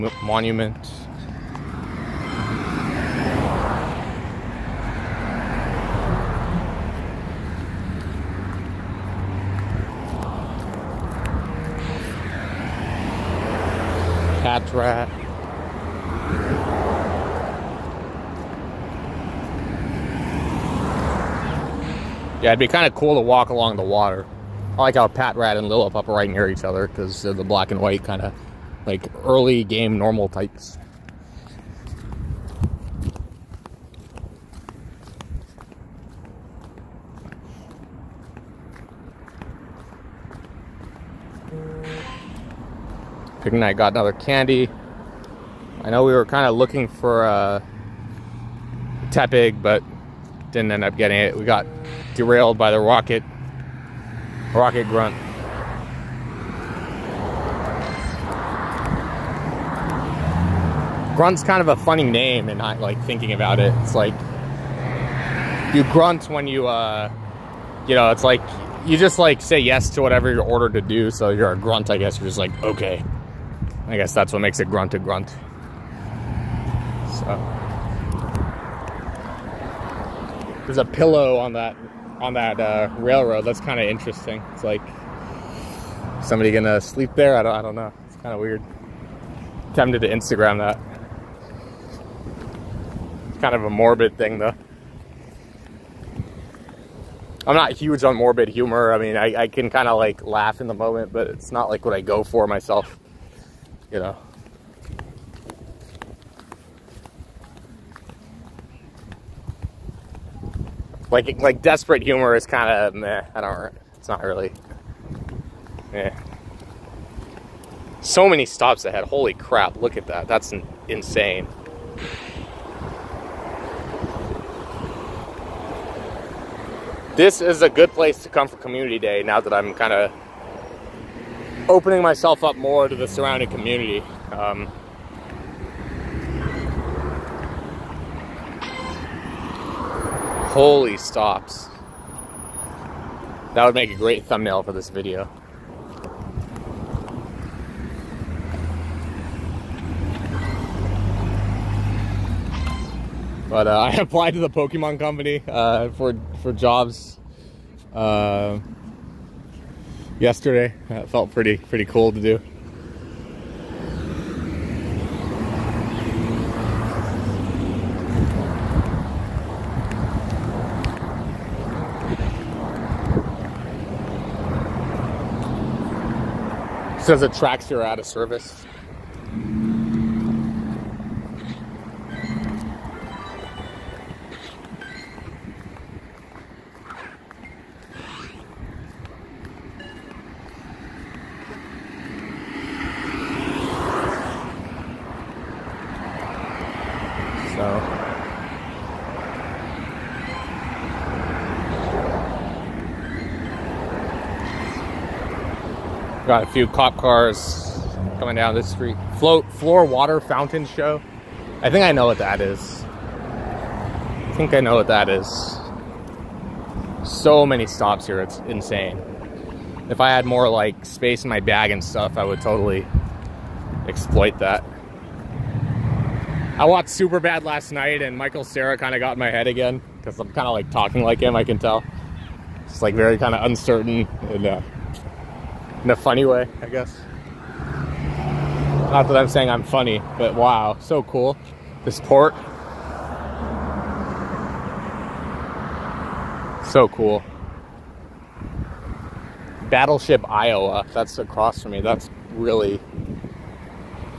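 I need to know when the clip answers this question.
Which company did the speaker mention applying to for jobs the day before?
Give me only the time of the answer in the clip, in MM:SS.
02:34.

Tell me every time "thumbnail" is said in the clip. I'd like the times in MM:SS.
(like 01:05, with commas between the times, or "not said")
02:24.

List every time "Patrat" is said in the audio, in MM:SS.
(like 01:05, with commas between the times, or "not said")
00:14, 00:25.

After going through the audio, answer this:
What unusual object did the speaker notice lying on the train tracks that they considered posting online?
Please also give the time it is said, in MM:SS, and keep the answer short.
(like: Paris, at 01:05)
A pillow, at 01:20.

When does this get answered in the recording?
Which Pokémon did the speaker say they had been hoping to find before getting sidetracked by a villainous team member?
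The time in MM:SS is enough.
00:49.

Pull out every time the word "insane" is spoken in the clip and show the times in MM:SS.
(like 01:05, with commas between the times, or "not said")
02:00, 03:38.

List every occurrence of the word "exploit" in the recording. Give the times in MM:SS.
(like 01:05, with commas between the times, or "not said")
03:43.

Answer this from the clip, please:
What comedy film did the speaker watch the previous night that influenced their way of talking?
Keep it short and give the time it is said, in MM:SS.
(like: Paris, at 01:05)
Superbad, at 03:46.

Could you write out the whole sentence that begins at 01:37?
I'm not huge on morbid humor.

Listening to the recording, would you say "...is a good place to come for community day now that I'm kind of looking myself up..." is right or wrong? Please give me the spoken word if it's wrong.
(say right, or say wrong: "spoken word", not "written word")
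wrong: "opening", not "looking".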